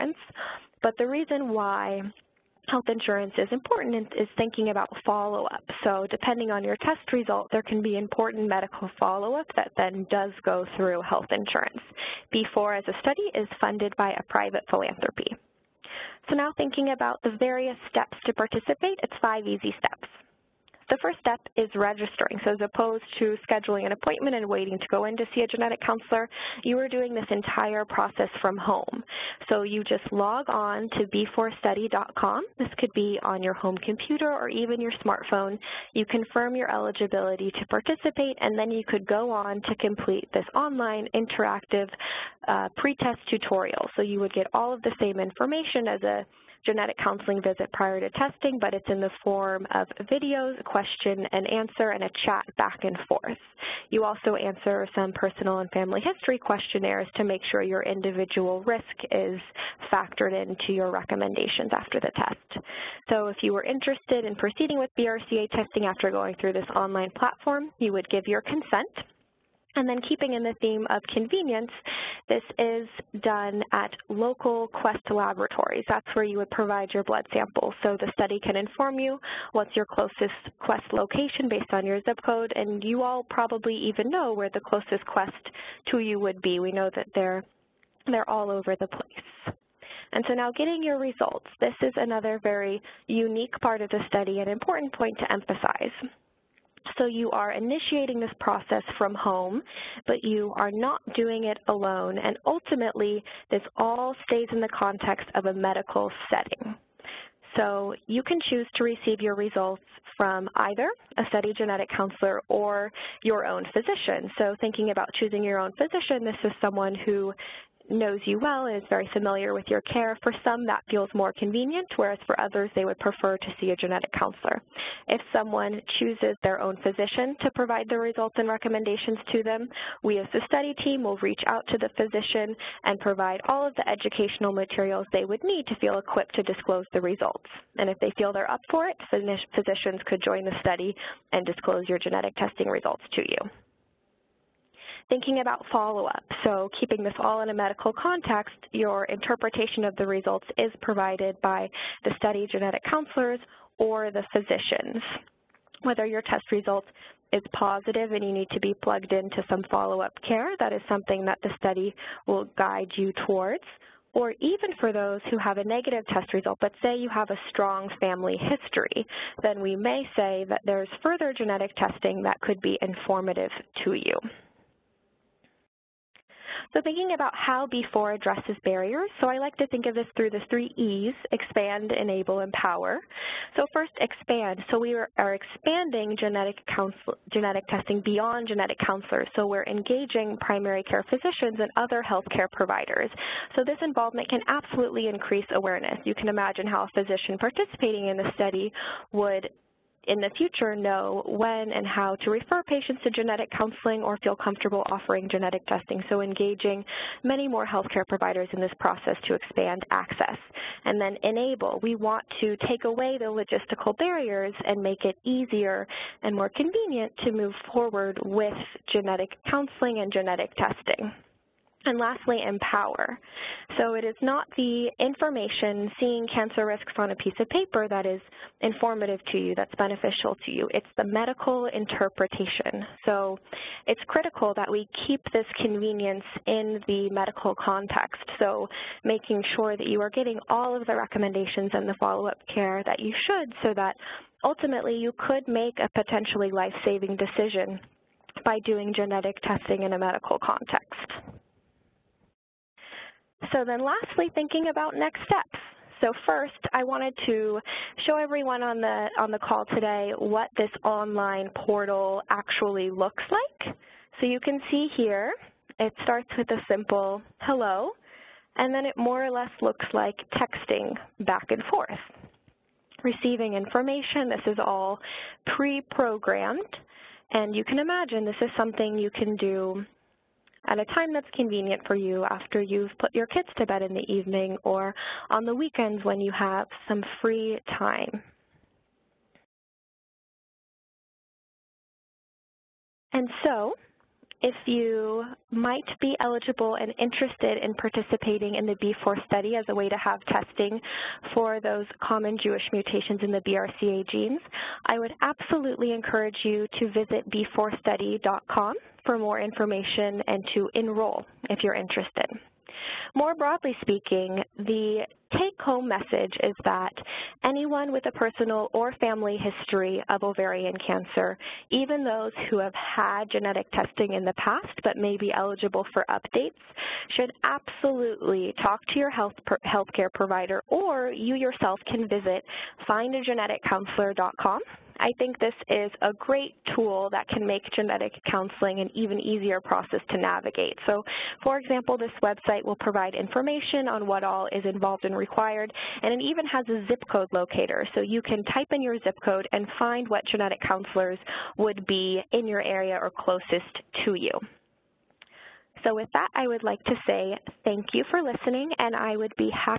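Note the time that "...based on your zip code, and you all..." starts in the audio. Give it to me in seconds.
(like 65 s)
81 s.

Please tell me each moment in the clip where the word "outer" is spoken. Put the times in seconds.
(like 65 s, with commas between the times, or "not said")
not said.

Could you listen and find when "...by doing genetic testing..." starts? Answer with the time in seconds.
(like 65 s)
248 s.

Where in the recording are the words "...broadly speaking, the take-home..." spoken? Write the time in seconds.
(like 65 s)
313 s.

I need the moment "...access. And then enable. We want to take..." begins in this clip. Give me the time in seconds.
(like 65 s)
209 s.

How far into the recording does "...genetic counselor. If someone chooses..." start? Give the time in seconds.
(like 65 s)
123 s.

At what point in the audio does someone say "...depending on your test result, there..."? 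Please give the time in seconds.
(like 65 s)
6 s.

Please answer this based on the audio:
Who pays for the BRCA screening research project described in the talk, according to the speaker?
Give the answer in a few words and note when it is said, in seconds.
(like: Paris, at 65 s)
Private philanthropy, at 14 s.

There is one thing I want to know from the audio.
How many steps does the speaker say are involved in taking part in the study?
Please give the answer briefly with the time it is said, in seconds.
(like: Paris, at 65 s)
5, at 19 s.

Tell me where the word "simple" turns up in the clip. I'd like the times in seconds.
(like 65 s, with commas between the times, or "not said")
266 s.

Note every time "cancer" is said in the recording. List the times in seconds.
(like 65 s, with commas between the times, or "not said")
226 s, 320 s.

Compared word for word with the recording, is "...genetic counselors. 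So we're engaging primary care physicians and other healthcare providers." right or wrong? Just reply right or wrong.
right.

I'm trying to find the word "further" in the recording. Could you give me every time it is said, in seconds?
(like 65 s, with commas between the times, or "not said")
171 s.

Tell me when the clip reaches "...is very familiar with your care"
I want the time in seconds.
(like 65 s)
118 s.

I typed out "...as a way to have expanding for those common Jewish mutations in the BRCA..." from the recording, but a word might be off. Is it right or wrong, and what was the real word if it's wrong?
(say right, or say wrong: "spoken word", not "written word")
wrong: "testing", not "expanding".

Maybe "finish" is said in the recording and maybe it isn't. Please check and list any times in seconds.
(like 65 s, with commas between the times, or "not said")
not said.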